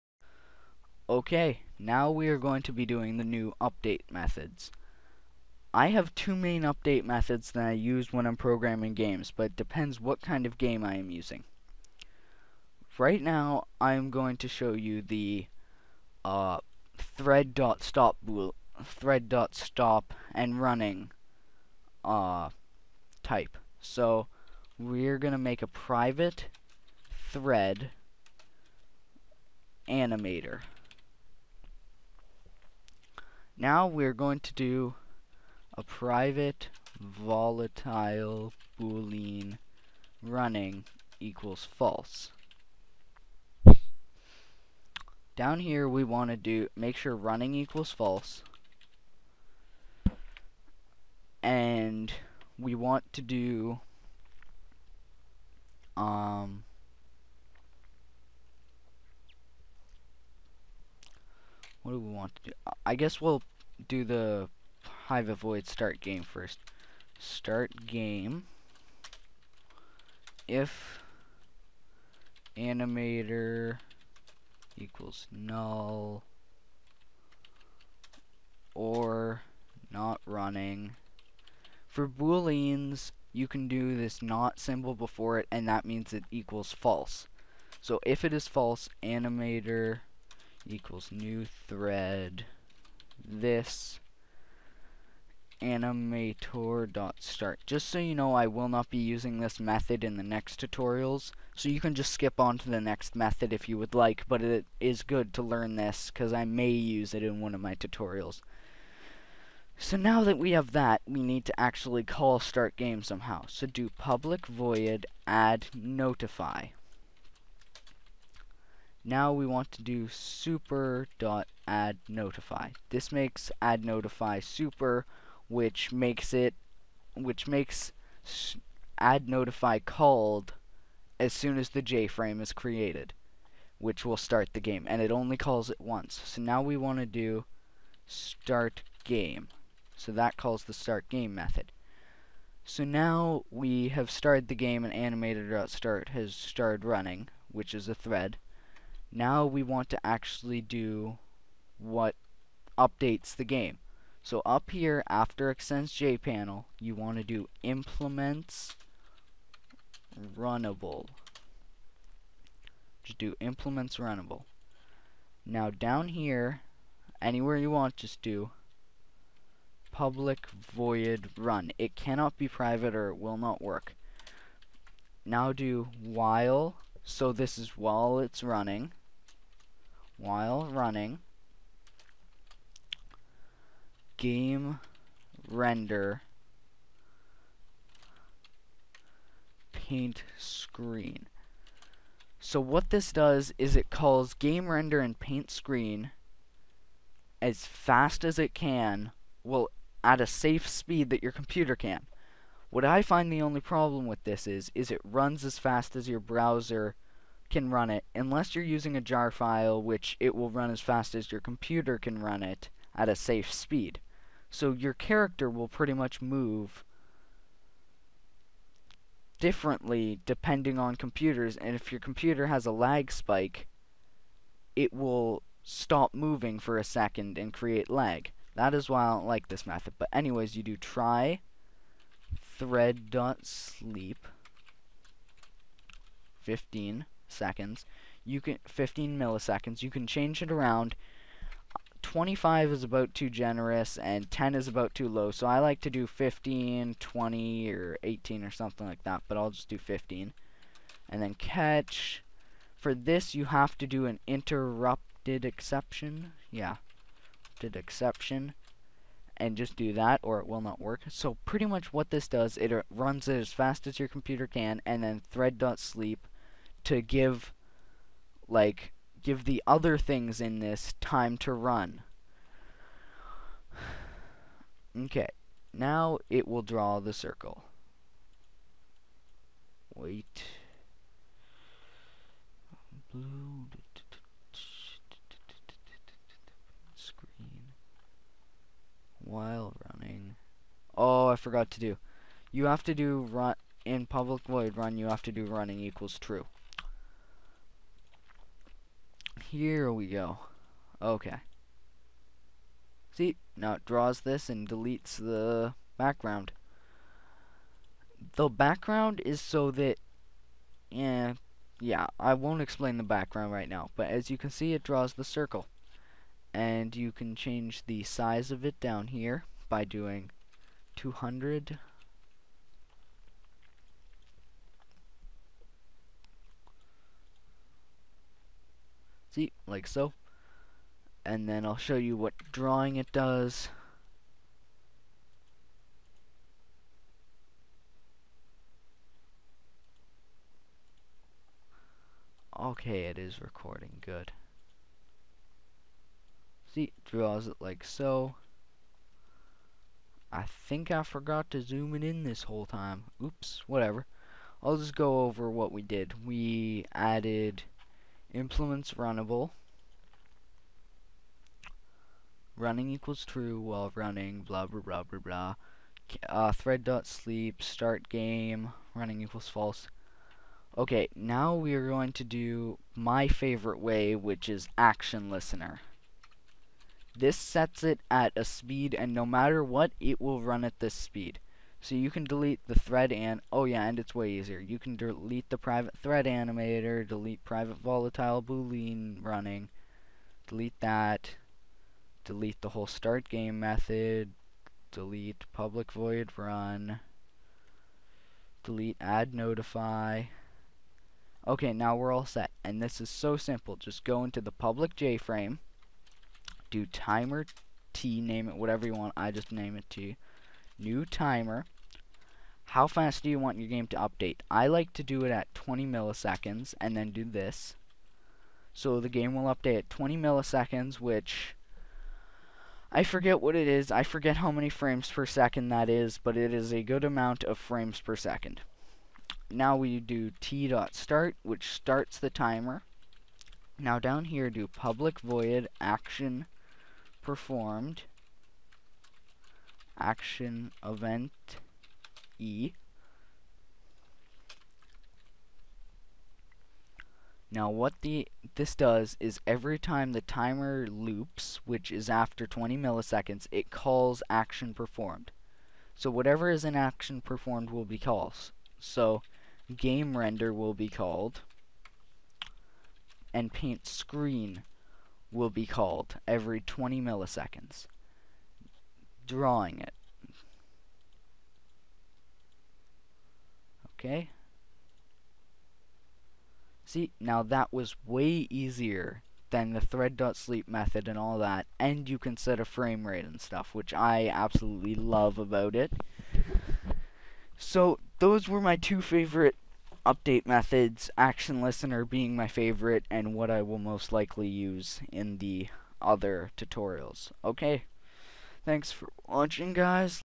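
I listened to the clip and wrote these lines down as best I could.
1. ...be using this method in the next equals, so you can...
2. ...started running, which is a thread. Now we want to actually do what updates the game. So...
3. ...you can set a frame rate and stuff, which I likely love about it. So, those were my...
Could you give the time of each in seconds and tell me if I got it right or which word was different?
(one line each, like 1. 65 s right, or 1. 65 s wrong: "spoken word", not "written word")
1. 98 s wrong: "tutorials", not "equals"
2. 146 s right
3. 482 s wrong: "absolutely", not "likely".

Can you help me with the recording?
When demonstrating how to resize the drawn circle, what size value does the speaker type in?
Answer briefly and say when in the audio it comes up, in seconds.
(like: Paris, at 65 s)
200, at 320 s.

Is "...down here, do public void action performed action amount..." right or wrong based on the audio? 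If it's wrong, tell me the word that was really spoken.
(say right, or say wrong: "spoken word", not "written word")
wrong: "event", not "amount".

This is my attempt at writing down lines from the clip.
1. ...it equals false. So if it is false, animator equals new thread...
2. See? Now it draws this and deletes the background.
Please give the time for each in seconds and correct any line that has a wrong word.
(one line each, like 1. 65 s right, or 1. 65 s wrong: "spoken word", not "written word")
1. 86 s right
2. 303 s right.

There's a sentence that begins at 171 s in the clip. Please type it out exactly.
It cannot be private or it will not work.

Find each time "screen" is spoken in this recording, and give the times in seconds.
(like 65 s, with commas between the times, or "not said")
190 s, 195 s, 286 s, 463 s.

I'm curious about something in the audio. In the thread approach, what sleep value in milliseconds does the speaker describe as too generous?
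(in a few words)
25.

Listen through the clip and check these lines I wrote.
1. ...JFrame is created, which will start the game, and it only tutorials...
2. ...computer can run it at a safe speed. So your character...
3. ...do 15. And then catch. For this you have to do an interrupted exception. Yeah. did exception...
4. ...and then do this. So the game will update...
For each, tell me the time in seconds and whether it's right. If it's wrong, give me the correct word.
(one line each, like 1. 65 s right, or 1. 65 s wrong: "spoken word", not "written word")
1. 131 s wrong: "calls", not "tutorials"
2. 211 s right
3. 249 s right
4. 416 s right.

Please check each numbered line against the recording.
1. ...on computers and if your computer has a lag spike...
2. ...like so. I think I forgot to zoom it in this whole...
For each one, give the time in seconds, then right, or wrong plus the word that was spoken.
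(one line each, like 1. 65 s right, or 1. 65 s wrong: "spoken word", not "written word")
1. 220 s right
2. 347 s right.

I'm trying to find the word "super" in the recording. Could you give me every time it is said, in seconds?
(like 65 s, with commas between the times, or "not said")
120 s, 124 s.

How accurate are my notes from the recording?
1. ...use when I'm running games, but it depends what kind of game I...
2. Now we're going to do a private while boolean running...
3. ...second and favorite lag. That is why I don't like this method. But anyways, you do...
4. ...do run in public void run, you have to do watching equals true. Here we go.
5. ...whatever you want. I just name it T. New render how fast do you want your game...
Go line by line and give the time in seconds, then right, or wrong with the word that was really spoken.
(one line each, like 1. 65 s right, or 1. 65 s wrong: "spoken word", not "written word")
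1. 7 s wrong: "programming", not "running"
2. 33 s wrong: "volatile", not "while"
3. 226 s wrong: "create", not "favorite"
4. 292 s wrong: "running", not "watching"
5. 408 s wrong: "timer", not "render".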